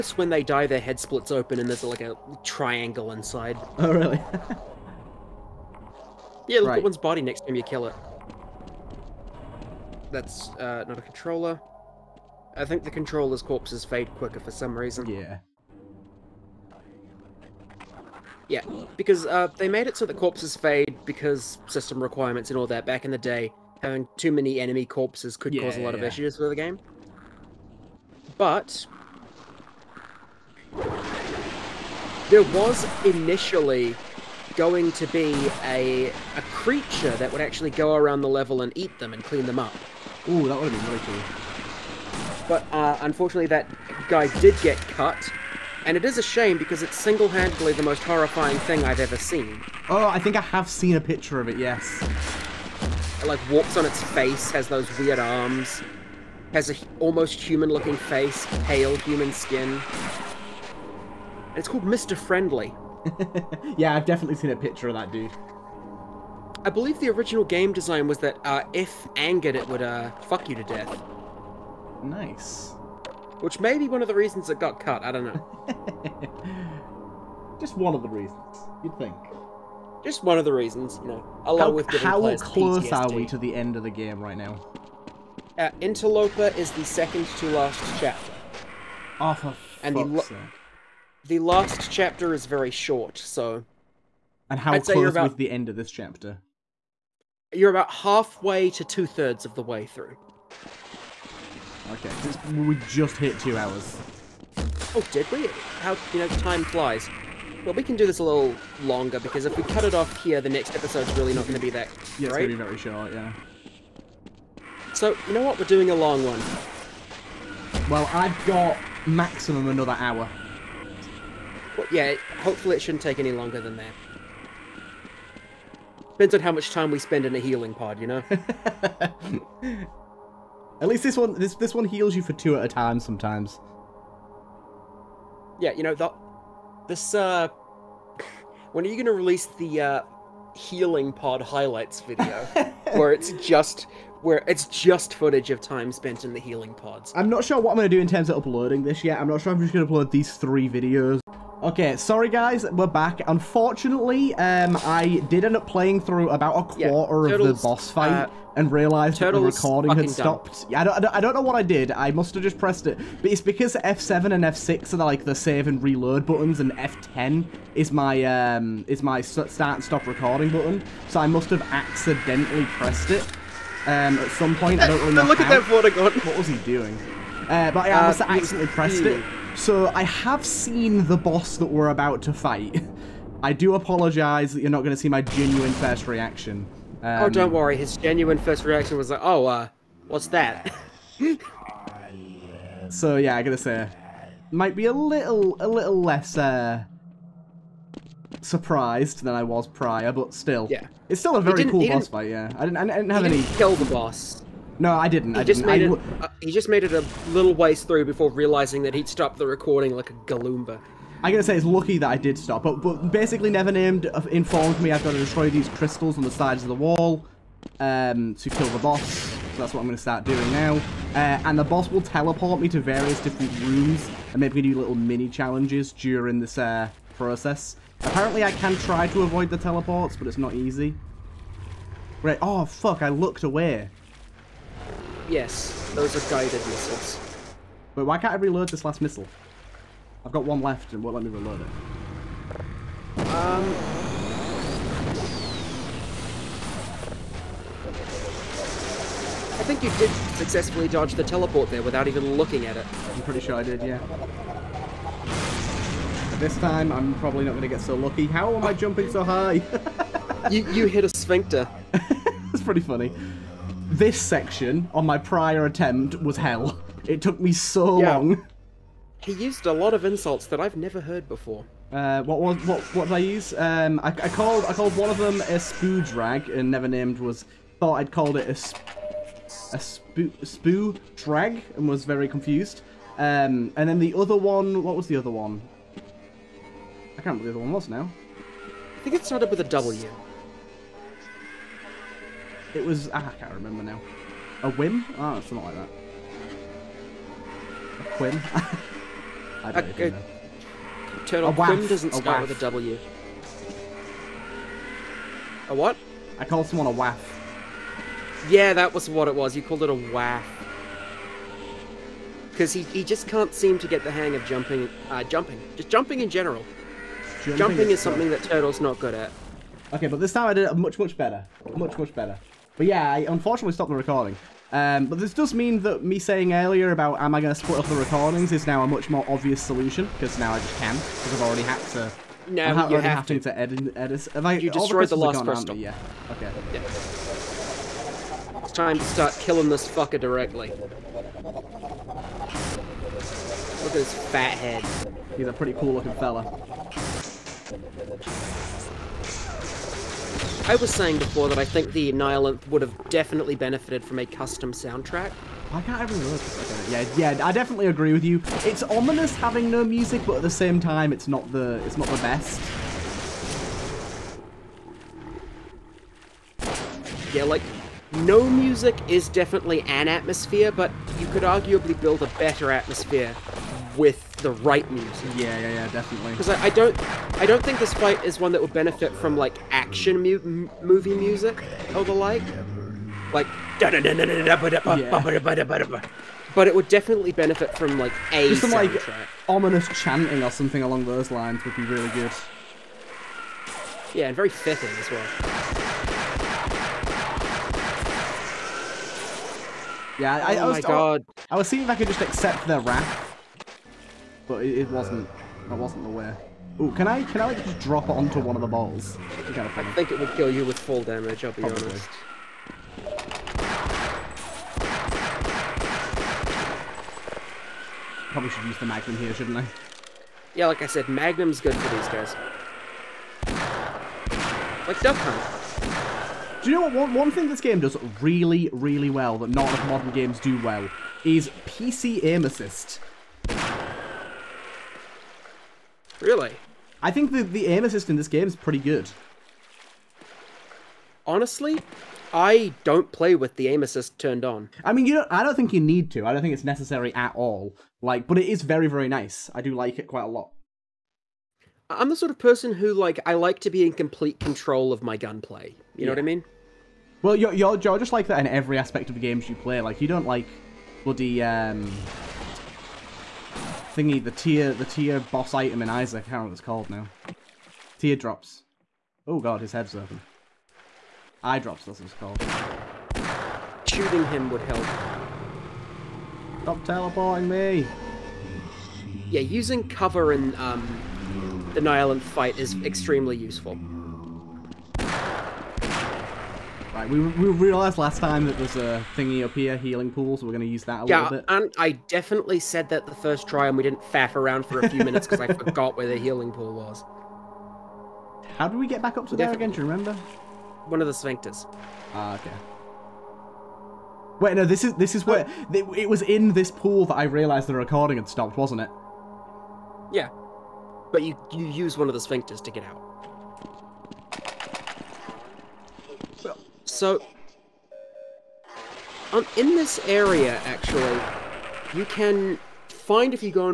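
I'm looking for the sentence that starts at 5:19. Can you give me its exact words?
Okay, but this time I did it much, much better.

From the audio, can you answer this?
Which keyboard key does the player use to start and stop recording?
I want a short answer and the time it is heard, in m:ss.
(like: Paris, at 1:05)
F10, at 2:46.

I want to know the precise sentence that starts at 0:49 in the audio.
Oh, I think I have seen a picture of it, yes.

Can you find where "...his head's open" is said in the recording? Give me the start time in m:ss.
7:49.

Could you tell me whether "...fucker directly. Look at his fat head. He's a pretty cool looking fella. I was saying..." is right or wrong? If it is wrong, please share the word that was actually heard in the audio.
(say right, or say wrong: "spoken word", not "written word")
right.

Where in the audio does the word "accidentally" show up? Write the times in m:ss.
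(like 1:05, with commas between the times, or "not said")
2:51, 2:58.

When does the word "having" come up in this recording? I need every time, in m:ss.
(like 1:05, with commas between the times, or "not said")
0:23, 5:59.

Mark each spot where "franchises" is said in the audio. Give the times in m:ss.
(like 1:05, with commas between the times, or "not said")
not said.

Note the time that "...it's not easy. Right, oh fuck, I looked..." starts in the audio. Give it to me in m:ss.
3:50.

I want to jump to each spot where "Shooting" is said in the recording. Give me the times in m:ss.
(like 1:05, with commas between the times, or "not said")
7:53.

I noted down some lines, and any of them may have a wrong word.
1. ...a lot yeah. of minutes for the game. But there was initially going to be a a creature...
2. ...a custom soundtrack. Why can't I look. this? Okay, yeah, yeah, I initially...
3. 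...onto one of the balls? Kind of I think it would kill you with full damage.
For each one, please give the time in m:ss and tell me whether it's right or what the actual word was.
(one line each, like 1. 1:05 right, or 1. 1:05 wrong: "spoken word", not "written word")
1. 0:25 wrong: "issues", not "minutes"
2. 5:54 wrong: "definitely", not "initially"
3. 6:48 right.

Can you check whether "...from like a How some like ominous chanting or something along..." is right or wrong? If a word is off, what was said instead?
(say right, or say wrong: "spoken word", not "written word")
wrong: "Just", not "How".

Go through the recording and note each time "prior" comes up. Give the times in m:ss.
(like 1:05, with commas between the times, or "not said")
3:19, 4:25.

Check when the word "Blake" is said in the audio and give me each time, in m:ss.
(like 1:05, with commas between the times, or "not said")
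not said.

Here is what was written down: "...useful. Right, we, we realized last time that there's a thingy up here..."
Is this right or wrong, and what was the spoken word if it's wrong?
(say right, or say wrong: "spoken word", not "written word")
right.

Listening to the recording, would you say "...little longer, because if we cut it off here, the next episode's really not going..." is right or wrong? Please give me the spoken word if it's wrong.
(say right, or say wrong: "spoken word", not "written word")
right.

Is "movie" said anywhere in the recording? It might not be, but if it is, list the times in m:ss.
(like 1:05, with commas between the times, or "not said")
6:20.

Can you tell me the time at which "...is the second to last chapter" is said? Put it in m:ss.
1:26.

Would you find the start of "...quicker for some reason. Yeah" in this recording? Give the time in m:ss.
0:14.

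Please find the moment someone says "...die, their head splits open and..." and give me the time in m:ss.
0:00.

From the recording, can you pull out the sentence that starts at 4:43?
Um, and then the other one, what was the other one?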